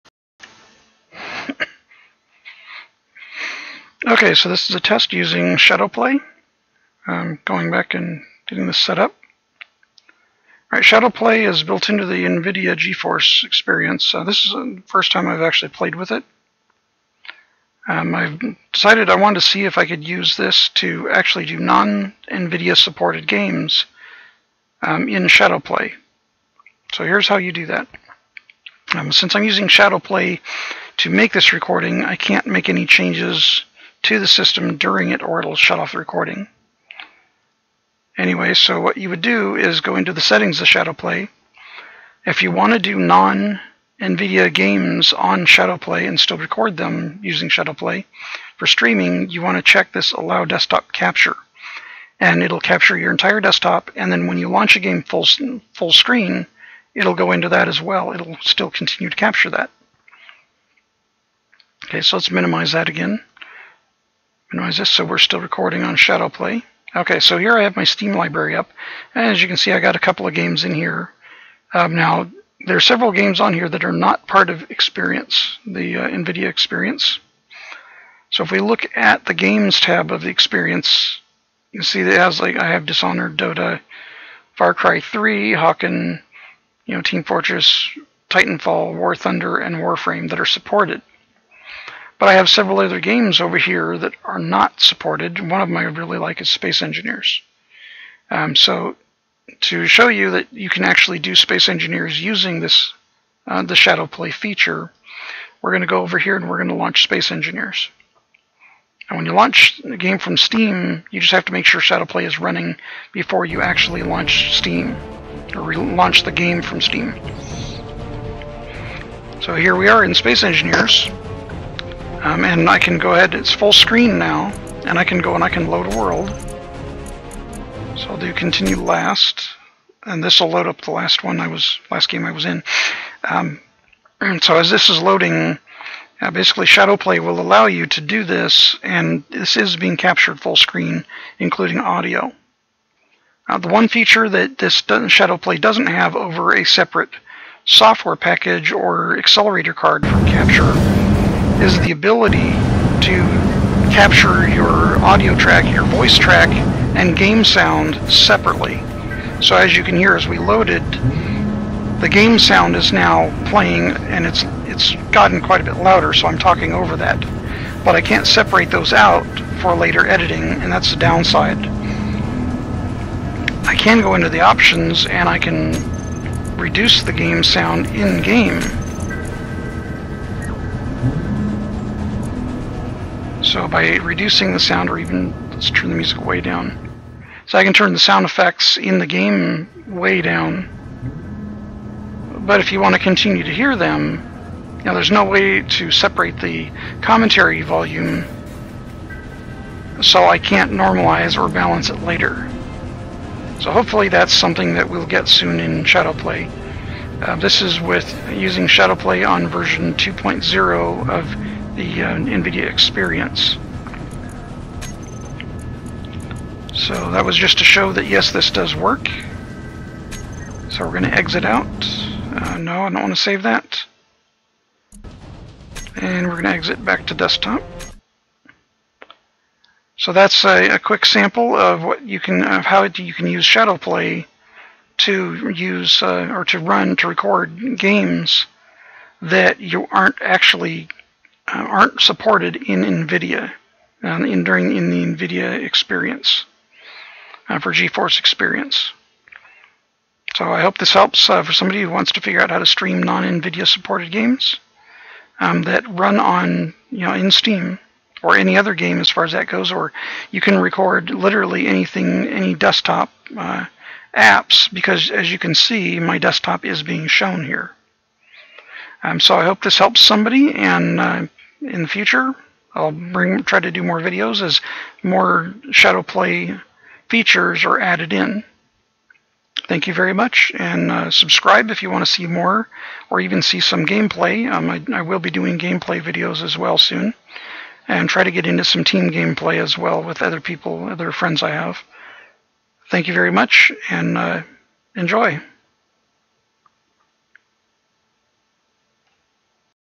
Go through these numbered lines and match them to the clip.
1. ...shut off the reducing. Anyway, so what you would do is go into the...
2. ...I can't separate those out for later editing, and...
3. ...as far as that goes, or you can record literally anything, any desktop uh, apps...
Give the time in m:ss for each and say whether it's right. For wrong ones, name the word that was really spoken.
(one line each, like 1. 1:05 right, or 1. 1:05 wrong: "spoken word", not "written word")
1. 0:35 wrong: "recording", not "reducing"
2. 2:47 right
3. 4:19 right.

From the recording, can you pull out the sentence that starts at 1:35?
One of them I really like is Space Engineers.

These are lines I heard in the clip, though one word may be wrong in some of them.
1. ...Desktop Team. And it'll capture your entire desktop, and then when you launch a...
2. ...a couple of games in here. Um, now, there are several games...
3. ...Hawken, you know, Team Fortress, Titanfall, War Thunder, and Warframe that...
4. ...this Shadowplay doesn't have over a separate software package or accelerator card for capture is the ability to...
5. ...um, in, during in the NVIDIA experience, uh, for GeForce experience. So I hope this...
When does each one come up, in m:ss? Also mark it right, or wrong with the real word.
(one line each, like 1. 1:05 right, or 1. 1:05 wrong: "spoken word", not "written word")
1. 0:50 wrong: "Capture", not "Team"
2. 1:09 right
3. 1:25 right
4. 2:24 right
5. 4:04 right.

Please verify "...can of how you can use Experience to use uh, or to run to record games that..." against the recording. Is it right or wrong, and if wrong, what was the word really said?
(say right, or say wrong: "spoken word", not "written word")
wrong: "Shadowplay", not "Experience".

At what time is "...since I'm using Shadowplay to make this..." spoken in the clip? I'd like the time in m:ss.
0:29.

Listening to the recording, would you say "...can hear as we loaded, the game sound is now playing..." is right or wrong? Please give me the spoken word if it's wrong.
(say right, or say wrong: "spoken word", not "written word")
right.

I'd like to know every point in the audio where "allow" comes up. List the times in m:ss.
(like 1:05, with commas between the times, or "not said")
0:50, 2:17.